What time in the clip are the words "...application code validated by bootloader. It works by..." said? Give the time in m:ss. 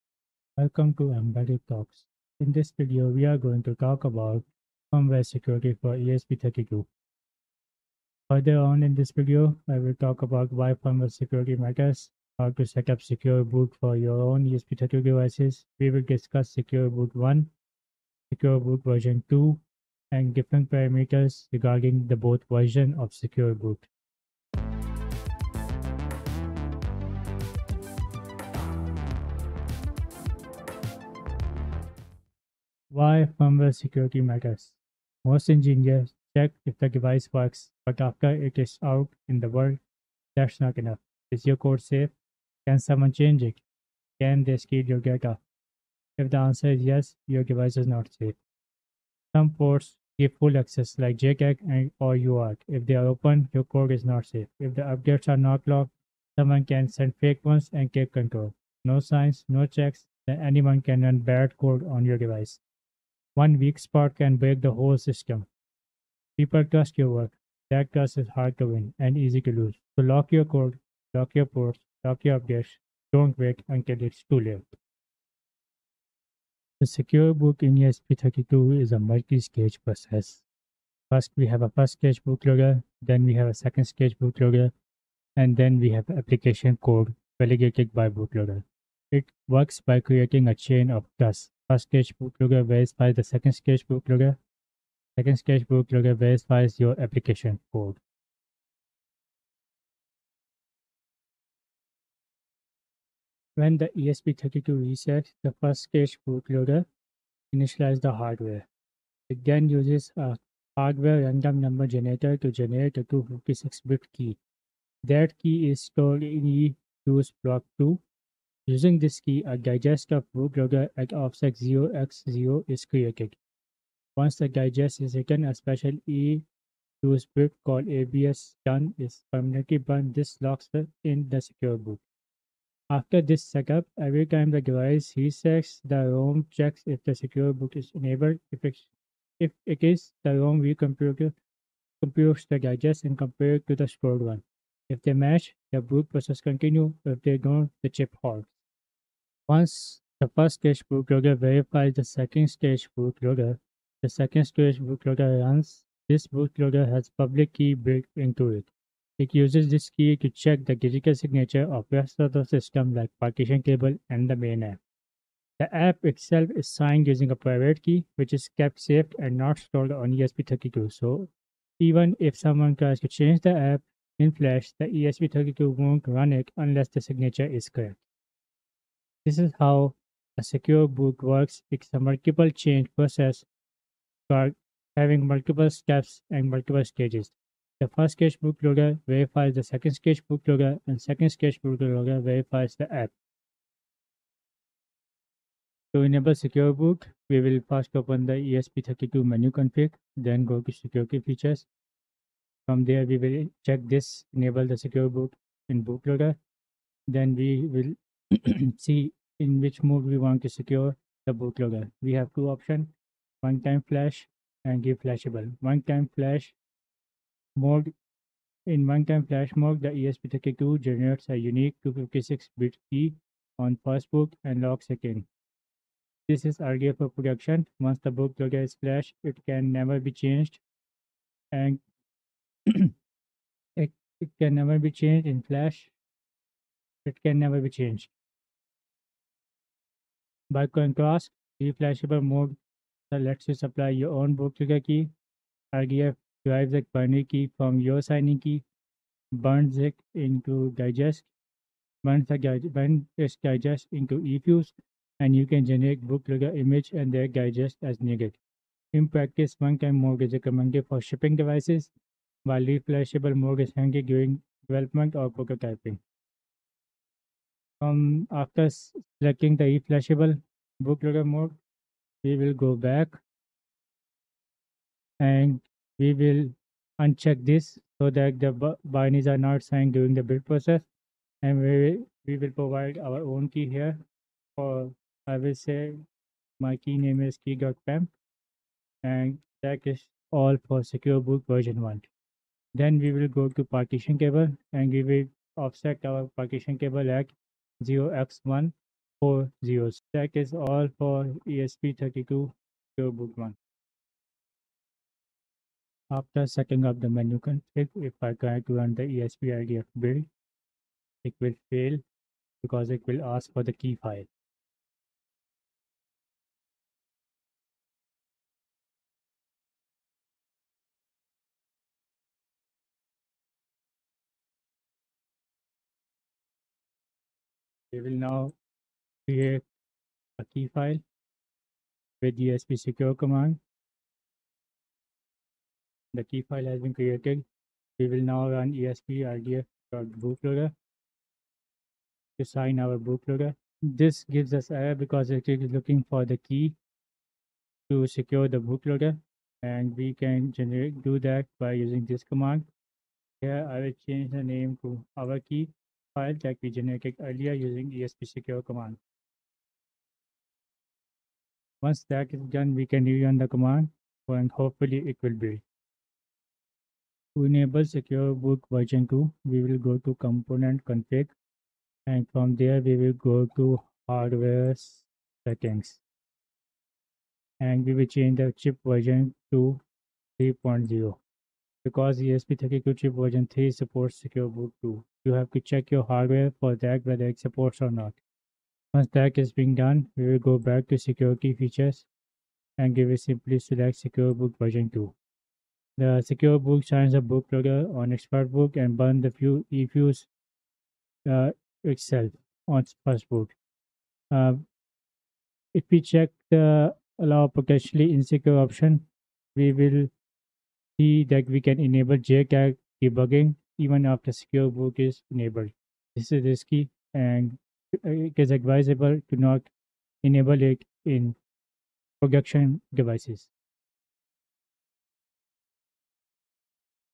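1:26.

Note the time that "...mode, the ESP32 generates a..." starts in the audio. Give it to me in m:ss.
3:39.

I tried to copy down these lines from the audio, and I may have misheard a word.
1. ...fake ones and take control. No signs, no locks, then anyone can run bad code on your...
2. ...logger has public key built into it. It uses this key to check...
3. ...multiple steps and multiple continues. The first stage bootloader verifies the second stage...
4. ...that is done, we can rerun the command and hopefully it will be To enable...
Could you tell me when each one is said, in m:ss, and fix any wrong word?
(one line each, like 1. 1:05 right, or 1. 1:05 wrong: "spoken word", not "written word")
1. 0:57 wrong: "checks", not "locks"
2. 2:36 right
3. 3:05 wrong: "stages", not "continues"
4. 6:02 right.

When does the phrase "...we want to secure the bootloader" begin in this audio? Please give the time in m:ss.
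3:30.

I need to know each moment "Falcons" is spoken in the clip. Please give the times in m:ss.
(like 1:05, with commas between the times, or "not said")
not said.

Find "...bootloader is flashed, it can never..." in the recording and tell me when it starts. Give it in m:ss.
3:48.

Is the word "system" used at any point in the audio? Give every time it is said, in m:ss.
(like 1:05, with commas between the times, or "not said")
1:04, 2:42.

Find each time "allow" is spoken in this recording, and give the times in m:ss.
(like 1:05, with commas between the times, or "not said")
6:47.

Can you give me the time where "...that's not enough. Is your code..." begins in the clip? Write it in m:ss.
0:40.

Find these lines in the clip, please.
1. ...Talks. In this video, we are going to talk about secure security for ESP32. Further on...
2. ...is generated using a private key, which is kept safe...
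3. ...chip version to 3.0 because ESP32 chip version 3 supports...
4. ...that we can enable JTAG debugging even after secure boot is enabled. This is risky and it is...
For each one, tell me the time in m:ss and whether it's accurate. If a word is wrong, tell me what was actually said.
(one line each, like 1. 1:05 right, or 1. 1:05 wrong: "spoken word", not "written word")
1. 0:01 wrong: "firmware", not "secure"
2. 2:46 wrong: "signed", not "generated"
3. 6:18 right
4. 6:51 right.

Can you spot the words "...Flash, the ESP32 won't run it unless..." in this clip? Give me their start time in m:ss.
2:54.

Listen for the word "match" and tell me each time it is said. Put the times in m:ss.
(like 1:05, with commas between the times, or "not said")
2:25.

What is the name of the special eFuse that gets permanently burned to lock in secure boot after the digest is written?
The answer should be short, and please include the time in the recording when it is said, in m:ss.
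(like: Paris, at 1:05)
abs done, at 2:07.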